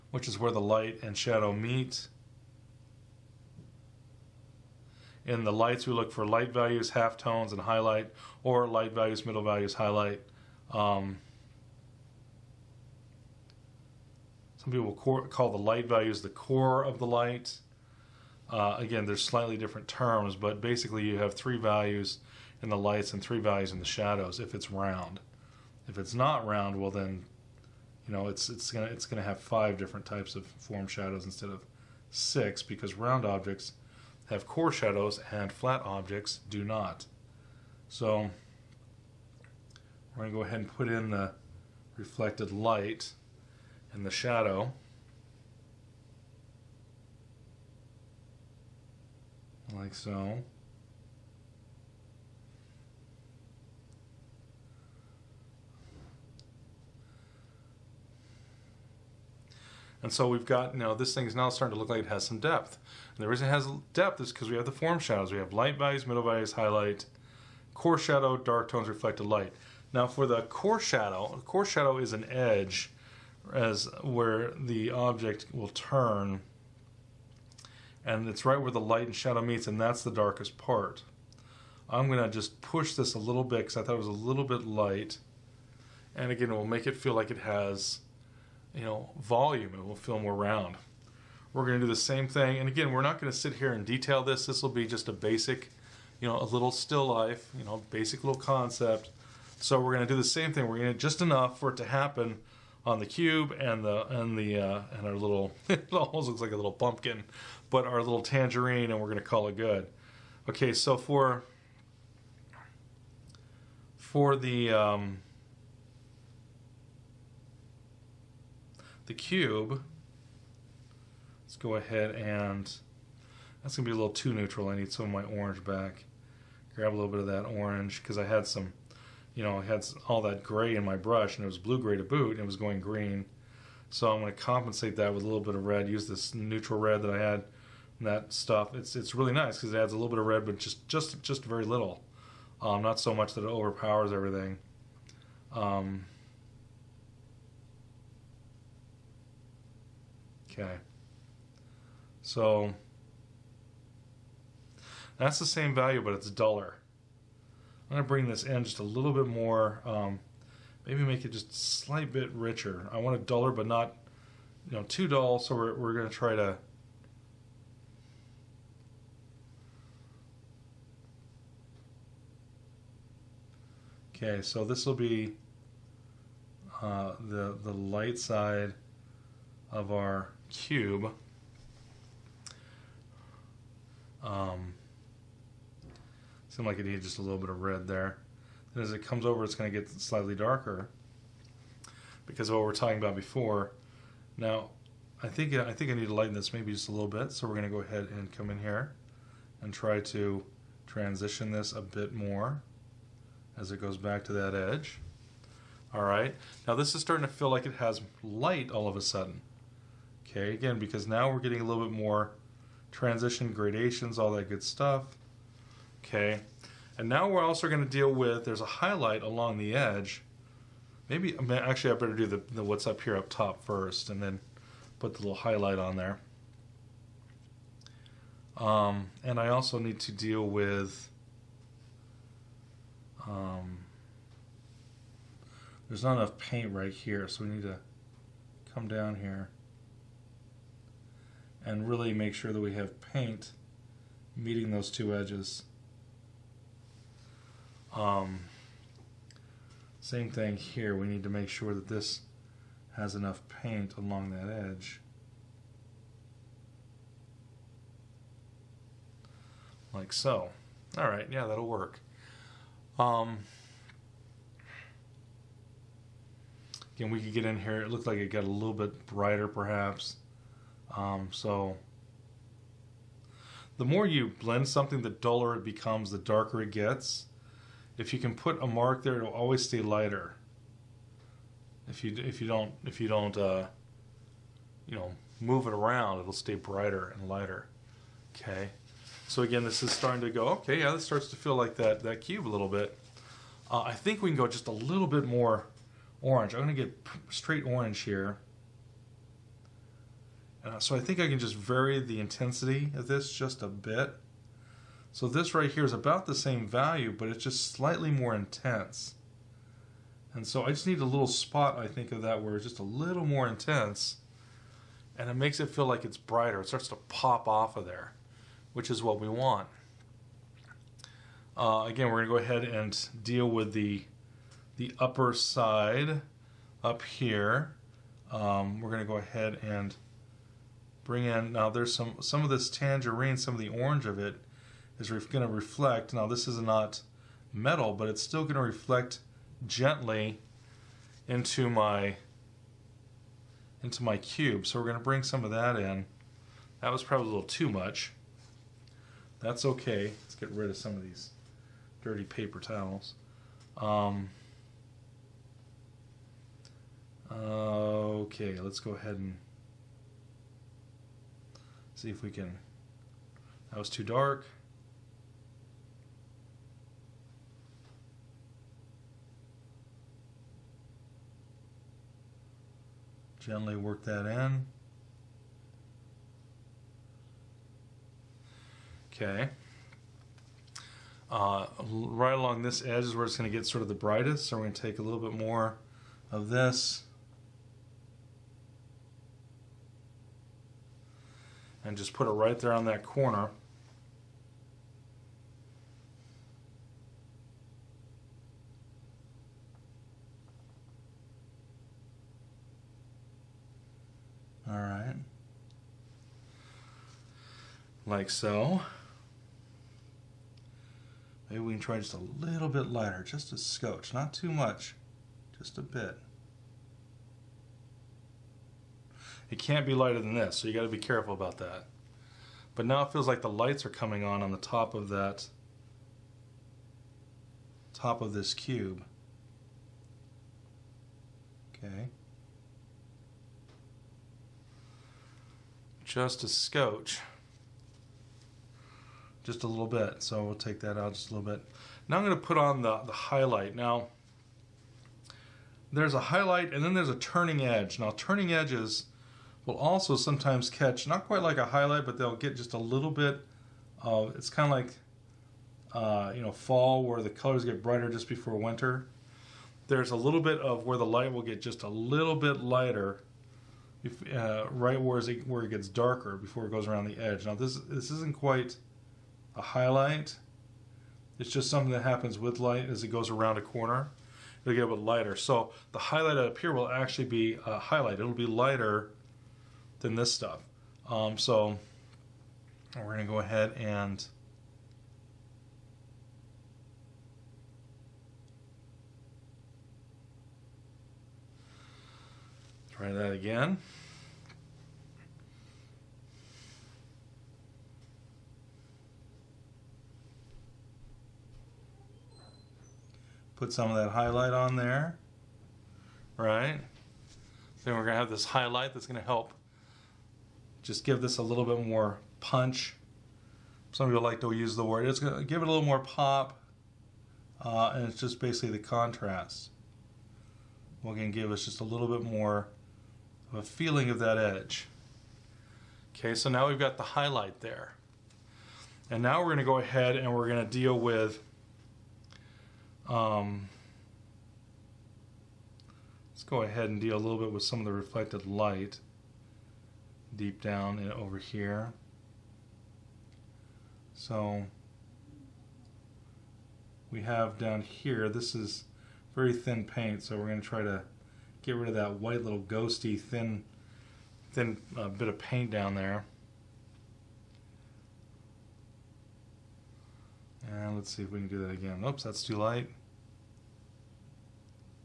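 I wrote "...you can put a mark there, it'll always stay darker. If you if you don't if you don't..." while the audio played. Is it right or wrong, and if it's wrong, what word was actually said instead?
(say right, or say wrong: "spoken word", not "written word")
wrong: "lighter", not "darker".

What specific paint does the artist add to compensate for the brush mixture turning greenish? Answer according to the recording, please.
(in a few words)
neutral red.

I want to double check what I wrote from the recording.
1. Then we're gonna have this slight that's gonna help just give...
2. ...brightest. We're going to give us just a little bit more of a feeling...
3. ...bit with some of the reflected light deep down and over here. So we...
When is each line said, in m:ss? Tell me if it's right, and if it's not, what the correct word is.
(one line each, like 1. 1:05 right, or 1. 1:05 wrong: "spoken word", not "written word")
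1. 8:27 wrong: "highlight", not "slight"
2. 8:38 wrong: "contrast", not "brightest"
3. 8:57 right.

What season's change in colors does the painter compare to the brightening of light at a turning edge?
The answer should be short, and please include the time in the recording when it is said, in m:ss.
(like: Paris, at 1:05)
fall, at 7:36.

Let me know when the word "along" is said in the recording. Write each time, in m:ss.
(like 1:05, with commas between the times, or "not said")
3:39, 4:13, 6:22.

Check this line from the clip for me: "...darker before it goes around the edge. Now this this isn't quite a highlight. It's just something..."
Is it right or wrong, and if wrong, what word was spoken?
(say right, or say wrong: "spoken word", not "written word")
right.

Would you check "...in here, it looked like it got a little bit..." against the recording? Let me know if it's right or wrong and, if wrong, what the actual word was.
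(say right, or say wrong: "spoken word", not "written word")
right.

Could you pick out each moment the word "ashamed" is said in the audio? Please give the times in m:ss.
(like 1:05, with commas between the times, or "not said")
not said.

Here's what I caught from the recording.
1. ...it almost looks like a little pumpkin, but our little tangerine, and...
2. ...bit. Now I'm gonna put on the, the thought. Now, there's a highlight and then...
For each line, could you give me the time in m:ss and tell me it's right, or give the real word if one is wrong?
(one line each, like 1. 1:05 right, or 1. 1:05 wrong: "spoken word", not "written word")
1. 1:45 right
2. 7:21 wrong: "highlight", not "thought".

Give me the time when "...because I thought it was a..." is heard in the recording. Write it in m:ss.
1:23.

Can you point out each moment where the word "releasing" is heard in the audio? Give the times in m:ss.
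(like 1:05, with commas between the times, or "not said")
not said.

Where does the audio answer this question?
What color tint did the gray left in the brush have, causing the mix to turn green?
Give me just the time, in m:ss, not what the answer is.
2:11.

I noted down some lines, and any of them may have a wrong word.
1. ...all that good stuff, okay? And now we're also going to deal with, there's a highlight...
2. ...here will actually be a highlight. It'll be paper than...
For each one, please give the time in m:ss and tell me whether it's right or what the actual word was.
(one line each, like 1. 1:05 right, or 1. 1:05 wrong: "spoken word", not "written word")
1. 3:34 right
2. 7:56 wrong: "lighter", not "paper".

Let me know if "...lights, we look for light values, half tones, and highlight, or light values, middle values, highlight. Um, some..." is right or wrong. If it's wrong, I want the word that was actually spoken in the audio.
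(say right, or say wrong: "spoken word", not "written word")
right.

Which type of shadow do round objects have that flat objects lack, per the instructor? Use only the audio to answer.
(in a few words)
core shadows.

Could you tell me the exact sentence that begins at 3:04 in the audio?
Um, seemed like it needed just a little bit of red there.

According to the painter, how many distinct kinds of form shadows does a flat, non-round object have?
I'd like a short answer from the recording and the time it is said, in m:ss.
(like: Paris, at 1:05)
5, at 0:29.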